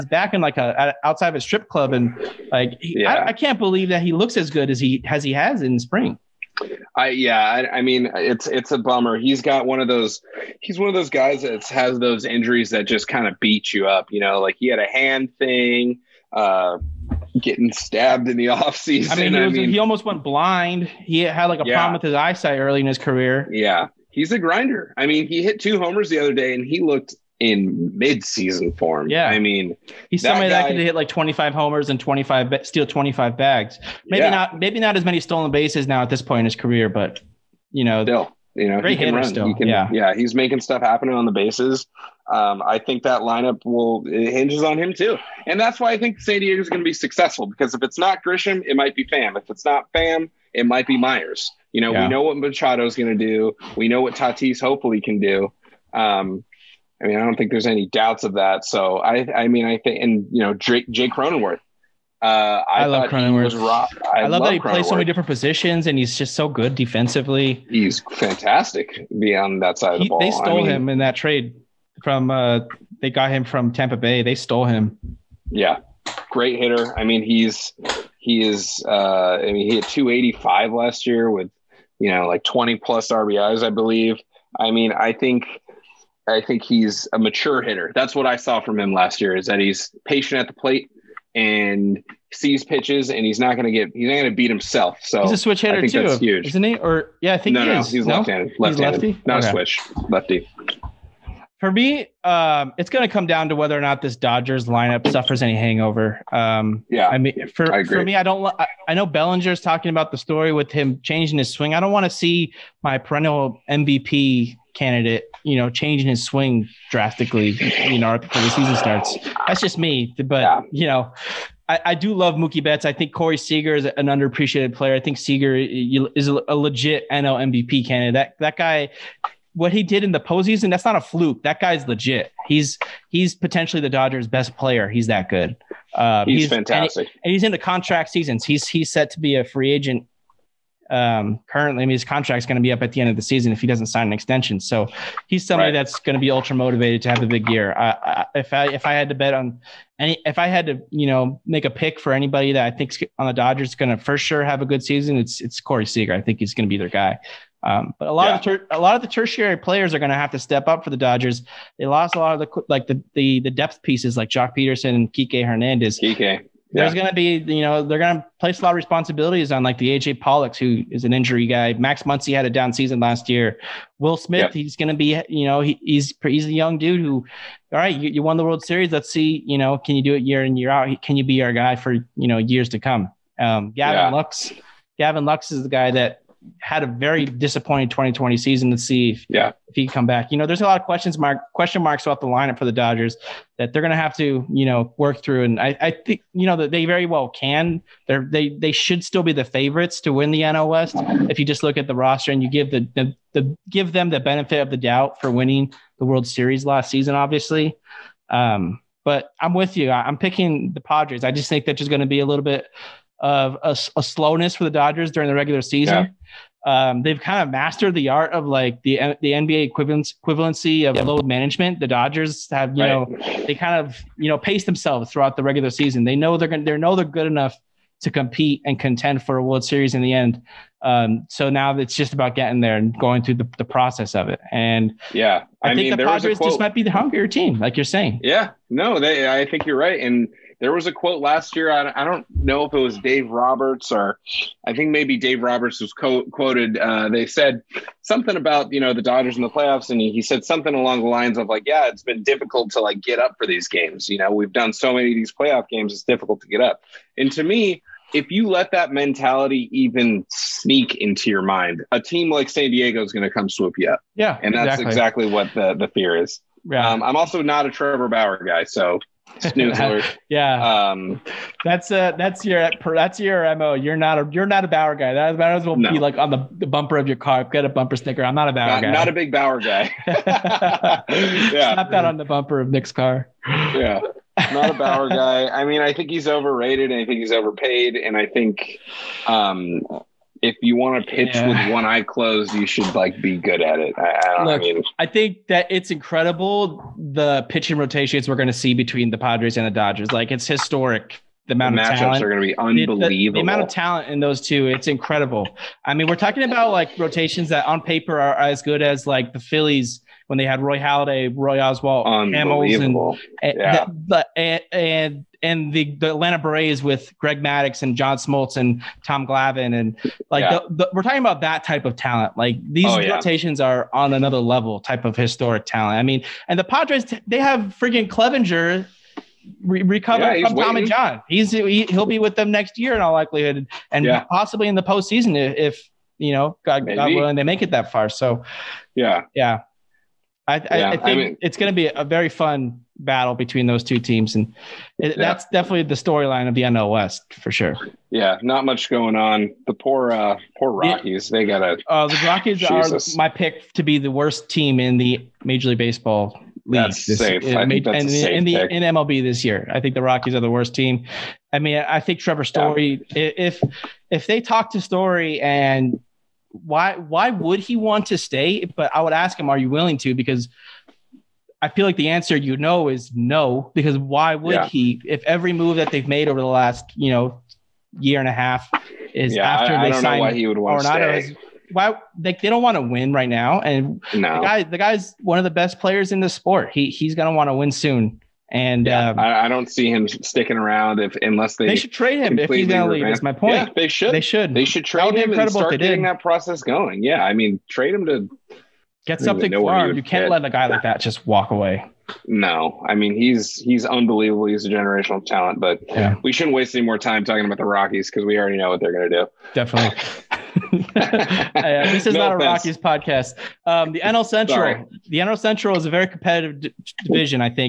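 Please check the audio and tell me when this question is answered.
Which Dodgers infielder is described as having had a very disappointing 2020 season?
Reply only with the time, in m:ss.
3:04.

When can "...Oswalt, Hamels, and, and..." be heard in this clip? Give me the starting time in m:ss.
5:11.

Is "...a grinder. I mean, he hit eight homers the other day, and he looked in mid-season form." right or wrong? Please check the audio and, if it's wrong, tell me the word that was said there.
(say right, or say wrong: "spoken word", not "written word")
wrong: "two", not "eight".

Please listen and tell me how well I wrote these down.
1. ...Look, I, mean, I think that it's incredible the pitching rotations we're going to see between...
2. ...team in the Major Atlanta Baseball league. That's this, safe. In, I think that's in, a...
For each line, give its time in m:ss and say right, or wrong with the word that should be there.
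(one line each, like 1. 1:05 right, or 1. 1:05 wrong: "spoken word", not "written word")
1. 4:54 right
2. 5:54 wrong: "League", not "Atlanta".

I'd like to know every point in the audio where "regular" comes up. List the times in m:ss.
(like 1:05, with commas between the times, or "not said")
3:35, 3:45.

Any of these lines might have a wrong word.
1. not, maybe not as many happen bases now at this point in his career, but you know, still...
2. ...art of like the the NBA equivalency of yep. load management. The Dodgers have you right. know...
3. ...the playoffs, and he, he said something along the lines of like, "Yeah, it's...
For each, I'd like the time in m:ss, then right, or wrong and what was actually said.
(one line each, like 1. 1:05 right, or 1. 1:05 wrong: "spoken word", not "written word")
1. 0:34 wrong: "stolen", not "happen"
2. 3:38 right
3. 4:09 right.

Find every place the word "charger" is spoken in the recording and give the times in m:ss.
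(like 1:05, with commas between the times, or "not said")
not said.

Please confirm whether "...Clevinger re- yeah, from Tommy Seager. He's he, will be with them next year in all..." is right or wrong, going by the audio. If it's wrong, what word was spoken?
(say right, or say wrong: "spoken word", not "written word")
wrong: "John", not "Seager".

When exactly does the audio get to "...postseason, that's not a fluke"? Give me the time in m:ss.
2:10.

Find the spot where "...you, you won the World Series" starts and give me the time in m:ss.
2:57.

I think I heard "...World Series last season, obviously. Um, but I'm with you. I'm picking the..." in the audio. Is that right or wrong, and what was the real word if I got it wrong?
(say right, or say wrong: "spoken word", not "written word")
right.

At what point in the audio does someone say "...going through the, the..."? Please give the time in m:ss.
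3:52.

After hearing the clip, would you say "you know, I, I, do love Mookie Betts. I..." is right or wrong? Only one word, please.
right.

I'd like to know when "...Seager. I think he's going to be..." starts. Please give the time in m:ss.
2:35.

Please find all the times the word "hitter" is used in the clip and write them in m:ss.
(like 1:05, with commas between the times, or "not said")
0:38, 1:16, 1:27, 1:35.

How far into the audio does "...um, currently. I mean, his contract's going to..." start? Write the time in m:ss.
2:20.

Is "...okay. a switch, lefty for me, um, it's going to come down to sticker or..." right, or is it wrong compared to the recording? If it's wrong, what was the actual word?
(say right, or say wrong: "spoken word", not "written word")
wrong: "whether", not "sticker".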